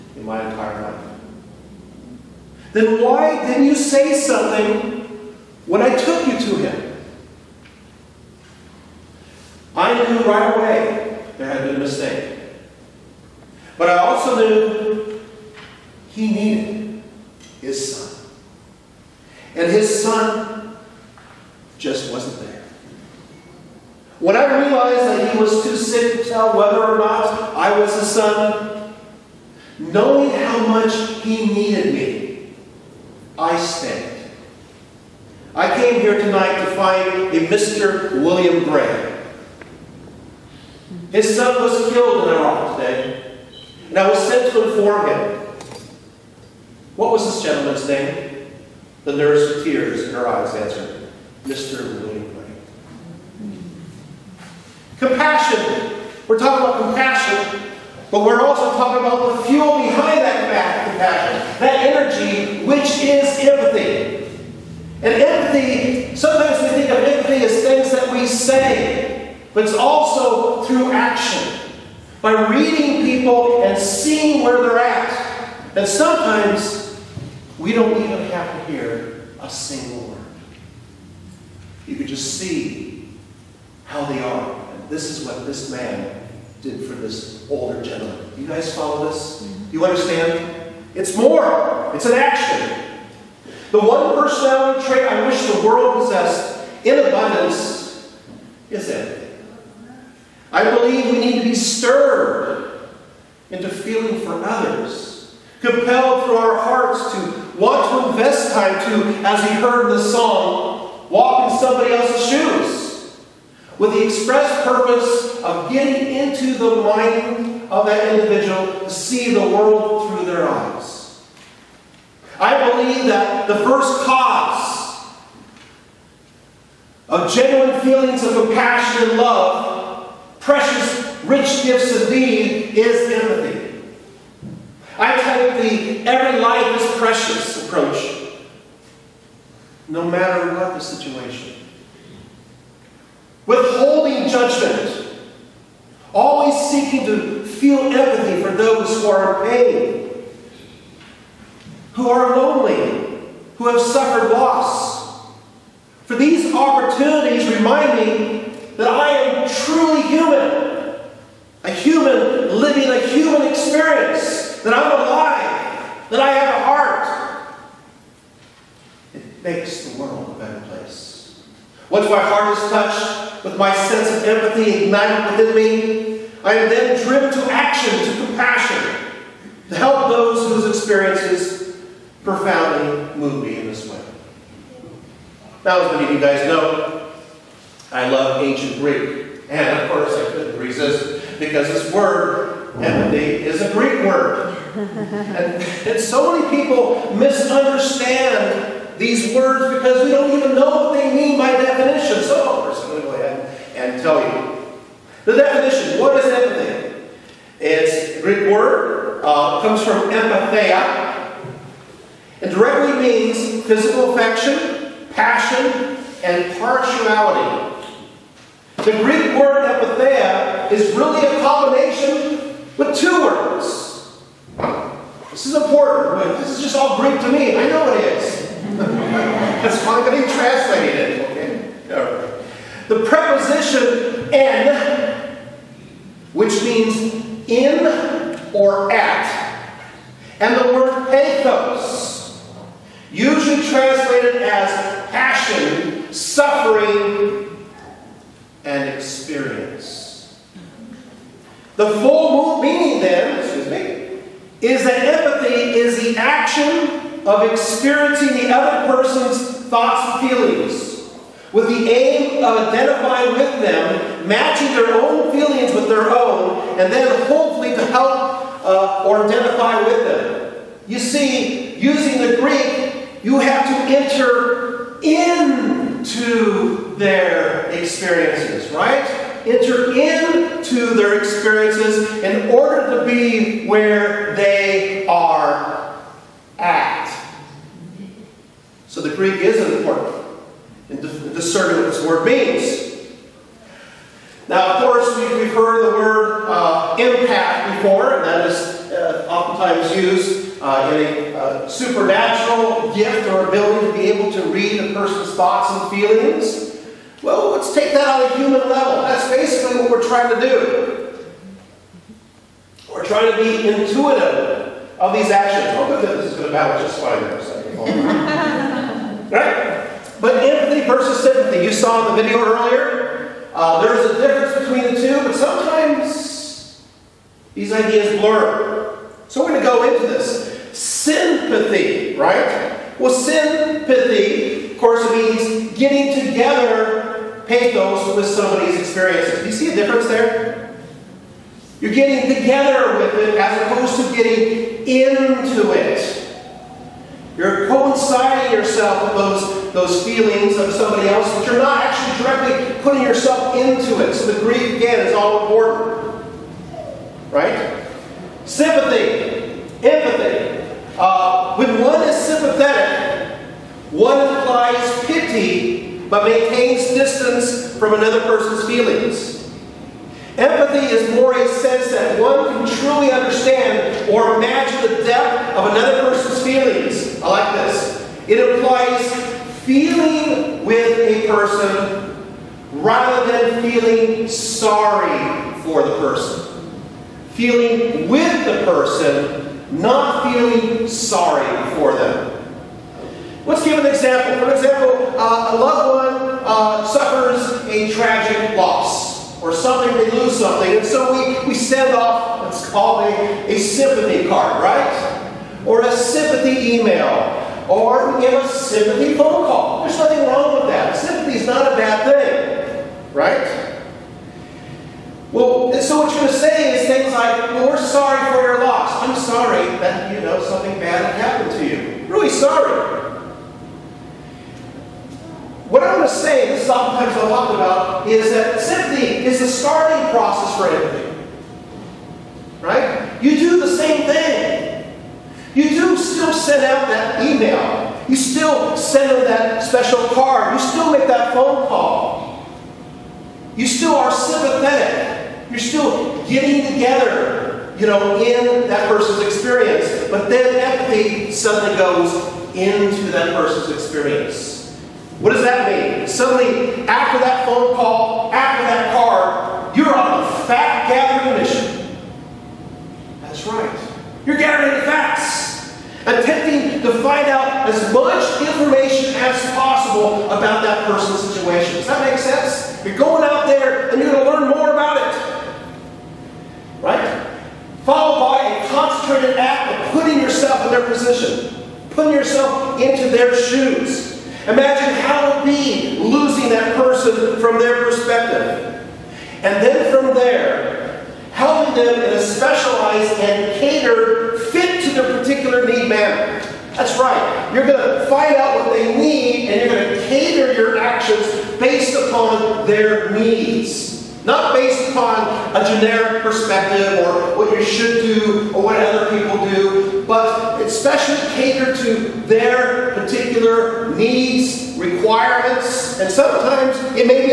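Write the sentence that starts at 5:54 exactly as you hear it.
So the grief, again, is all important.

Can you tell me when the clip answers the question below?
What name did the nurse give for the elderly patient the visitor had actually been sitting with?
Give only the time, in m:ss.
0:51.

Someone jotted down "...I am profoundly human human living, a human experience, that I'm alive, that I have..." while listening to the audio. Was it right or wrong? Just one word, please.
wrong.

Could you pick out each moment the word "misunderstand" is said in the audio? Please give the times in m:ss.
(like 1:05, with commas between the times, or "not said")
3:17.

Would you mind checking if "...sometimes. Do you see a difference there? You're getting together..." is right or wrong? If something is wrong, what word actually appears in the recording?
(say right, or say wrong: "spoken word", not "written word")
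wrong: "experiences", not "sometimes".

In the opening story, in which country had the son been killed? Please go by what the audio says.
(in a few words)
Iraq.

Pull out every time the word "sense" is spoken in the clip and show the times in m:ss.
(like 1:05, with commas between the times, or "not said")
2:53, 6:11, 7:52.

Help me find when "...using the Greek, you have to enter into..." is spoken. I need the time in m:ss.
4:31.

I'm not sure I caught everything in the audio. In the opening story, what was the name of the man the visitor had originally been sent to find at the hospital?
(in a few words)
William Gray.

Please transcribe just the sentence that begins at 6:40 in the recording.
And so we, we send off, what's called a, a sympathy card, right?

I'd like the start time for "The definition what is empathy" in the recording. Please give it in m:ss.
3:25.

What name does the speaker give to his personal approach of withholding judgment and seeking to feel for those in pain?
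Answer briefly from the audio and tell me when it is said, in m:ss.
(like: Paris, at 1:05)
Every Life is Precious, at 2:16.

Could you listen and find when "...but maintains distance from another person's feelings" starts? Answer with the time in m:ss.
6:06.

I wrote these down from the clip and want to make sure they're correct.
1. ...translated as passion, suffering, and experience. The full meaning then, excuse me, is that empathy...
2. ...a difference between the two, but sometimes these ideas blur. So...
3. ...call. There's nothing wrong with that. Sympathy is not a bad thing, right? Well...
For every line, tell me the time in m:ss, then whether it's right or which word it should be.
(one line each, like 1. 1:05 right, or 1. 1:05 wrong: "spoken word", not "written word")
1. 4:03 right
2. 5:24 right
3. 6:49 right.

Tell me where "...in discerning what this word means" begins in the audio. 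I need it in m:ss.
4:50.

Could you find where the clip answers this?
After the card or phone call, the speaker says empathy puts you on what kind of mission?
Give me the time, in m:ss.
7:40.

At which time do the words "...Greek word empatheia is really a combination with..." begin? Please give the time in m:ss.
3:39.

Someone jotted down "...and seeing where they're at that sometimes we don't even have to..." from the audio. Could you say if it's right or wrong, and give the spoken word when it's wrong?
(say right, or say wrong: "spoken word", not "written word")
right.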